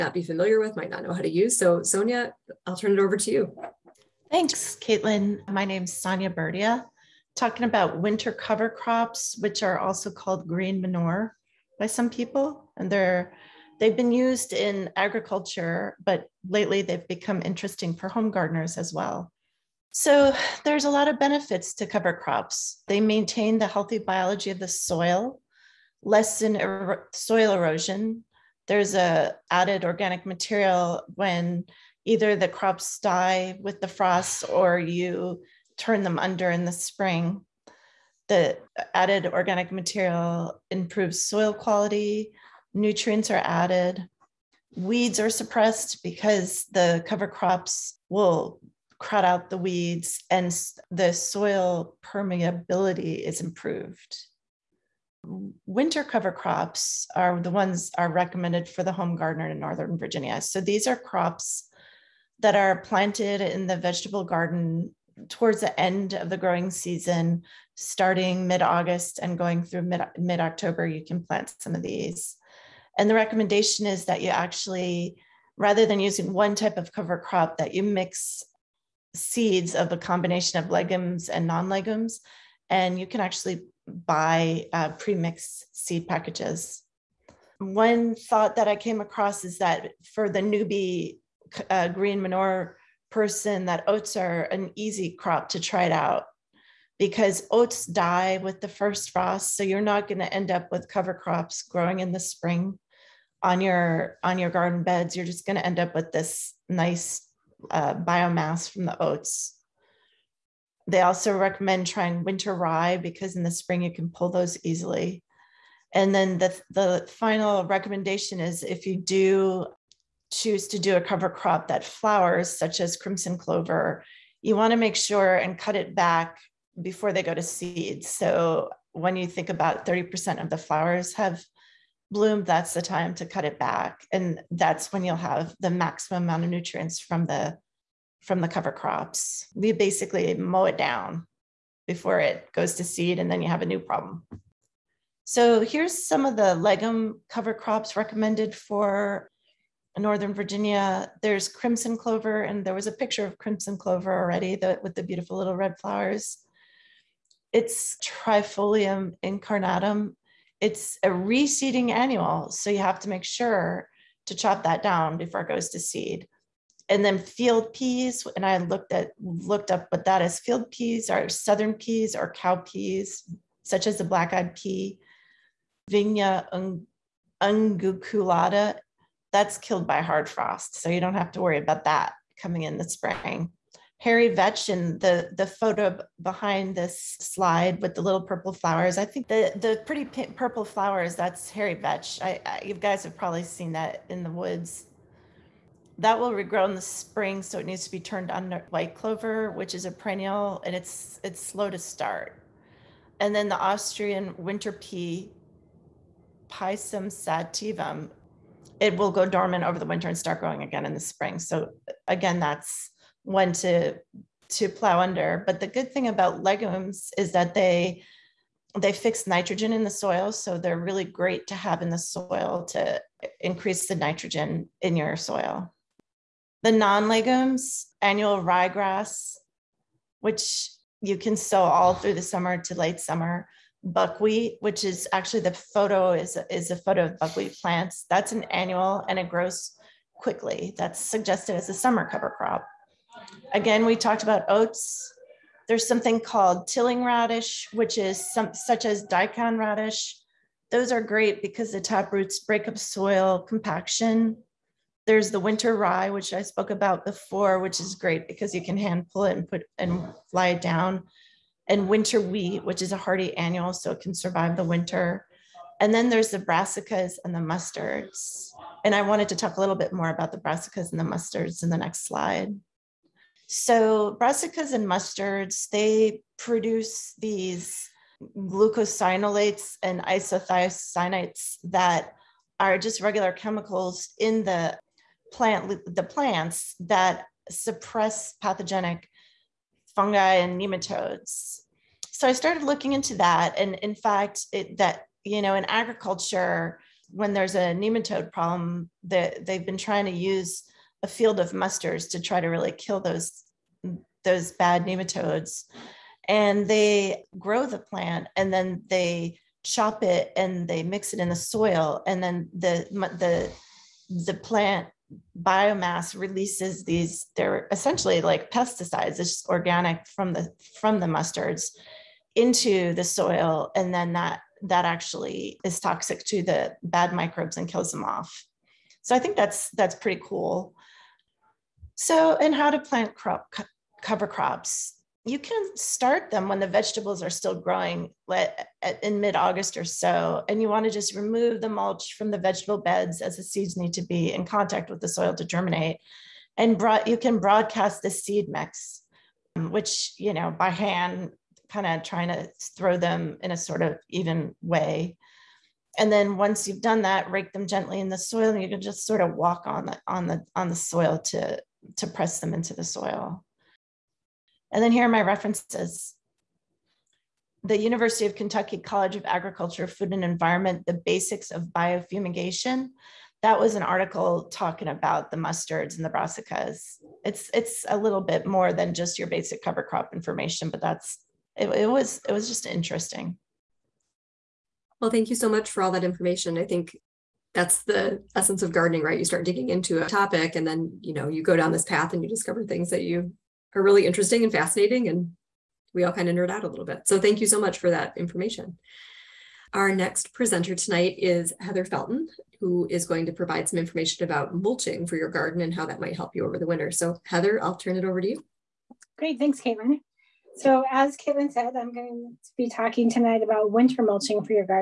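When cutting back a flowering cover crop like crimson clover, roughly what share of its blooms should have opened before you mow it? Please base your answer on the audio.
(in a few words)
30%.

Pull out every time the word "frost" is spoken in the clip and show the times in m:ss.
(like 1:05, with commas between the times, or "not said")
0:33, 1:39, 3:00.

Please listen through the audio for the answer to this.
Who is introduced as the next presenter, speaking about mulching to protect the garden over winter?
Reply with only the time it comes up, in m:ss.
6:41.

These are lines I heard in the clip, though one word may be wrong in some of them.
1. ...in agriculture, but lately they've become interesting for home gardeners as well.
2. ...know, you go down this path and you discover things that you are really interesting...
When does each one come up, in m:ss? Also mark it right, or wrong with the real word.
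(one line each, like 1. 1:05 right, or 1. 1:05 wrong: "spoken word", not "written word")
1. 0:14 right
2. 6:31 right.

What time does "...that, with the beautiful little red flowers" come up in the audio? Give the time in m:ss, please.
2:34.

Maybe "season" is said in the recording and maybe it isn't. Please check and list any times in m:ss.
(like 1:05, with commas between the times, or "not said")
1:06.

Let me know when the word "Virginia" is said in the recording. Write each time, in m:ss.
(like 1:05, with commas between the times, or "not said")
0:59, 2:30.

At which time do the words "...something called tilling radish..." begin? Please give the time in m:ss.
4:05.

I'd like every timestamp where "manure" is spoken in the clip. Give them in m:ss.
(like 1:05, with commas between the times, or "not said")
0:10, 1:32.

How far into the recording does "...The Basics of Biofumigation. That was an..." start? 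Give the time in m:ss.
6:10.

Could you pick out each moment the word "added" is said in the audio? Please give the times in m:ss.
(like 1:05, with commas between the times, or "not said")
0:29, 0:38, 0:43.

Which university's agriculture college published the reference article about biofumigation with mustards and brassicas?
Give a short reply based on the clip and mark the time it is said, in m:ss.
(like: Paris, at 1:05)
University of Kentucky, at 6:07.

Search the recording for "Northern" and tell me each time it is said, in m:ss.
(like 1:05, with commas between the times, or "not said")
0:59, 2:29.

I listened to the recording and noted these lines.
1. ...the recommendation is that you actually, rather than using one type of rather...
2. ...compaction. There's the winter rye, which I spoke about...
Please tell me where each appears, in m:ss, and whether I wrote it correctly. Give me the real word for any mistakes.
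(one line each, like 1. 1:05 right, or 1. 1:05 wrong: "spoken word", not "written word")
1. 1:13 wrong: "cover", not "rather"
2. 4:13 right.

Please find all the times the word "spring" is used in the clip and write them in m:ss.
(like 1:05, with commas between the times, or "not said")
0:36, 1:42, 1:53, 3:02, 3:16, 3:30.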